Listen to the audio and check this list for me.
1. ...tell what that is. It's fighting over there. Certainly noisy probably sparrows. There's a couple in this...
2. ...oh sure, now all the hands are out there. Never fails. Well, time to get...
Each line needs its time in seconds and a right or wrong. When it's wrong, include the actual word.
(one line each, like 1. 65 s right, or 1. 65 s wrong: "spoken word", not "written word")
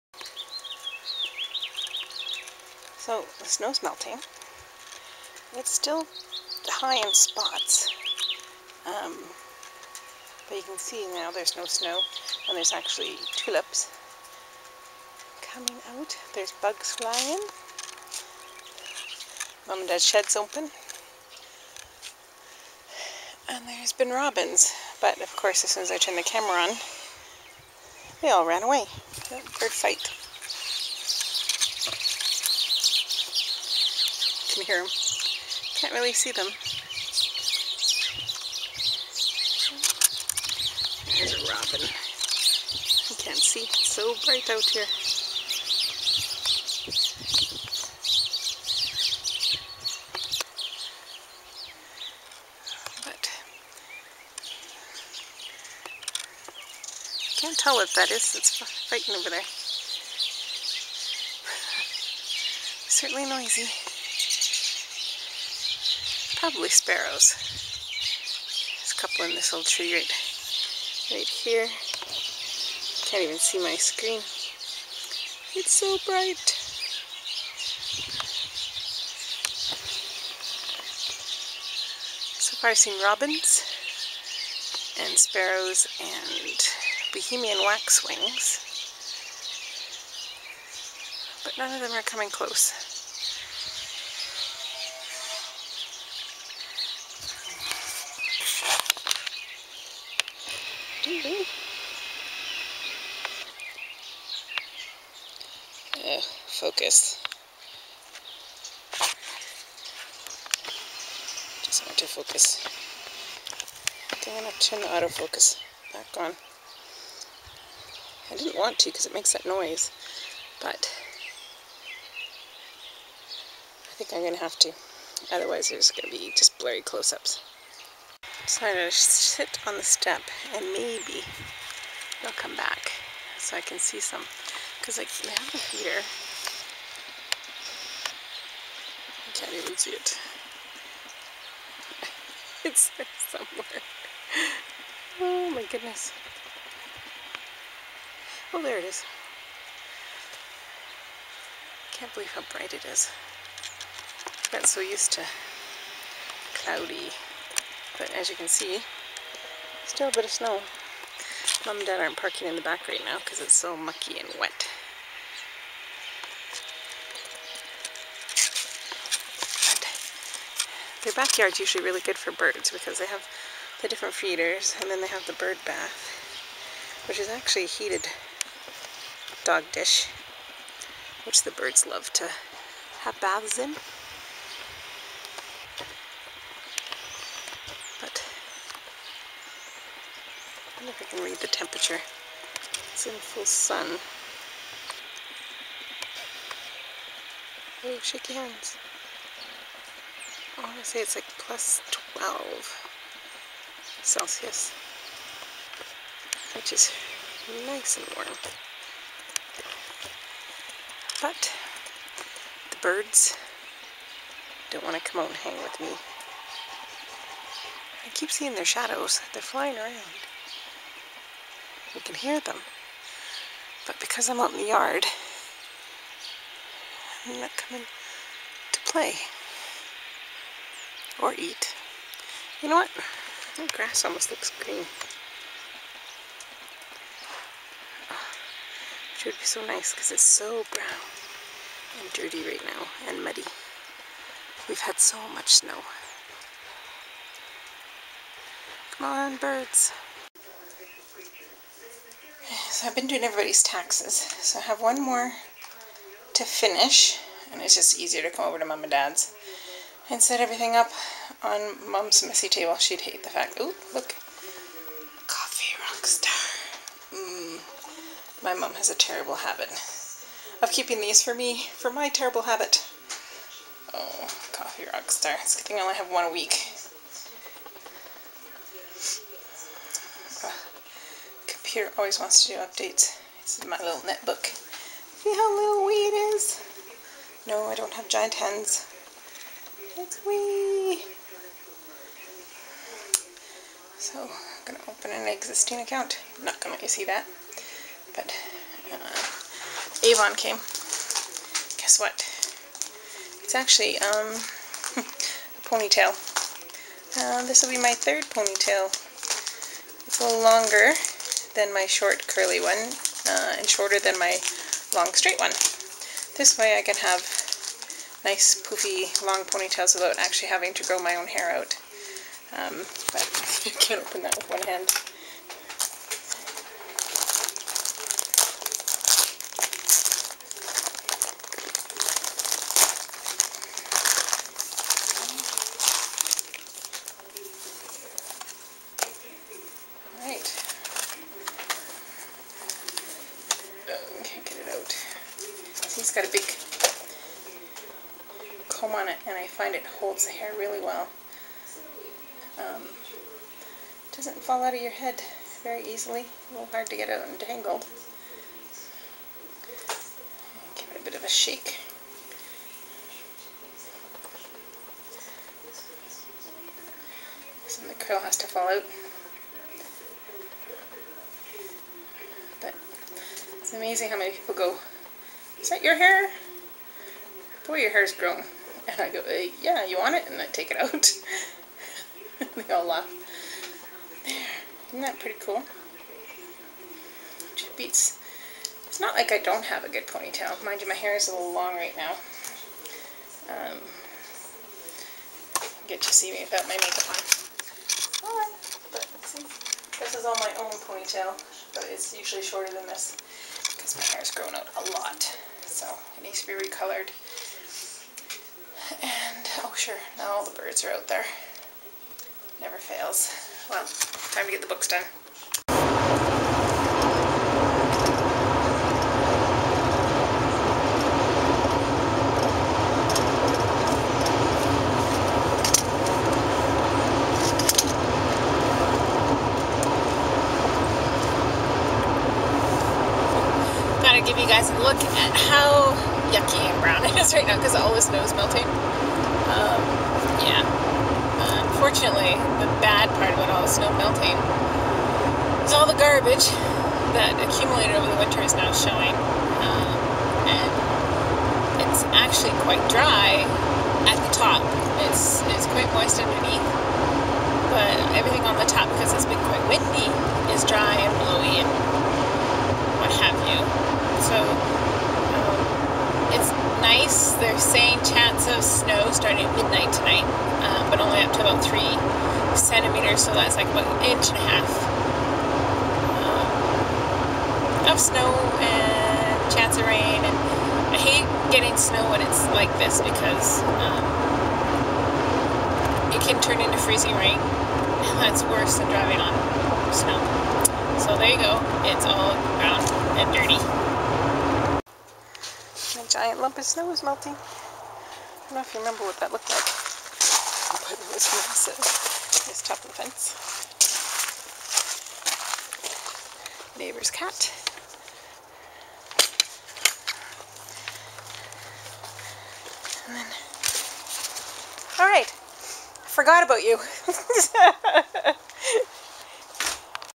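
1. 57 s right
2. 409 s wrong: "birds", not "hands".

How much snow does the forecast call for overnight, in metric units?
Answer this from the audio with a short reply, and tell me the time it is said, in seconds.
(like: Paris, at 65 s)
3 centimeters, at 471 s.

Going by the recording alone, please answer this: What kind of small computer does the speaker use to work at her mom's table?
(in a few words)
Netbook.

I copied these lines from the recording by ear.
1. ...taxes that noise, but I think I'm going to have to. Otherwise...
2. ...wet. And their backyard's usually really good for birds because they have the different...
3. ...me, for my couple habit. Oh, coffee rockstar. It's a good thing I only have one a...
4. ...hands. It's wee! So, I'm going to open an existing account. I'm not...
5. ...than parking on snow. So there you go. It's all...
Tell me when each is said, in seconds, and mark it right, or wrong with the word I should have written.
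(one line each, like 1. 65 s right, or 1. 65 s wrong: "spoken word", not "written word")
1. 119 s wrong: "makes", not "taxes"
2. 164 s right
3. 271 s wrong: "terrible", not "couple"
4. 288 s right
5. 488 s wrong: "driving", not "parking".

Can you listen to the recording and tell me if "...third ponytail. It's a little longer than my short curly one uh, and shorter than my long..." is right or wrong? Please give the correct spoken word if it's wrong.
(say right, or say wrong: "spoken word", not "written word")
right.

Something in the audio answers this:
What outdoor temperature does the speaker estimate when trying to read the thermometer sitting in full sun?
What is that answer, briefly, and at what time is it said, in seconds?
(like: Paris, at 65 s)
Plus 12 Celsius, at 201 s.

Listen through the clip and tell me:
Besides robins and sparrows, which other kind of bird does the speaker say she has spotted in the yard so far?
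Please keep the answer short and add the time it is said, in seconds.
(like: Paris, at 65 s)
Bohemian waxwings, at 87 s.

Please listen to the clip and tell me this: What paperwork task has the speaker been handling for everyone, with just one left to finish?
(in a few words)
Taxes.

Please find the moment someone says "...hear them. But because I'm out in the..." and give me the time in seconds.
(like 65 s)
222 s.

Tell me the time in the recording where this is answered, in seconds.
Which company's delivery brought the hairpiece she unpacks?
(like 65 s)
300 s.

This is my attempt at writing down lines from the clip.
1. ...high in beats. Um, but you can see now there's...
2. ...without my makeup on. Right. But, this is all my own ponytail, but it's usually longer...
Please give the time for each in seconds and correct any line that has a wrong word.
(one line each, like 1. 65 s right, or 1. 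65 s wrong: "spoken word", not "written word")
1. 6 s wrong: "spots", not "beats"
2. 396 s wrong: "shorter", not "longer".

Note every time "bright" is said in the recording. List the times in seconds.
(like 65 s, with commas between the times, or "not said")
44 s, 76 s, 152 s.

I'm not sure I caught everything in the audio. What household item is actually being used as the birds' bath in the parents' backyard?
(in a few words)
Heated dog dish.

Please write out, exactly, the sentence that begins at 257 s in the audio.
And it's just easier to come over to mom and dad's and set everything up on mom's messy table.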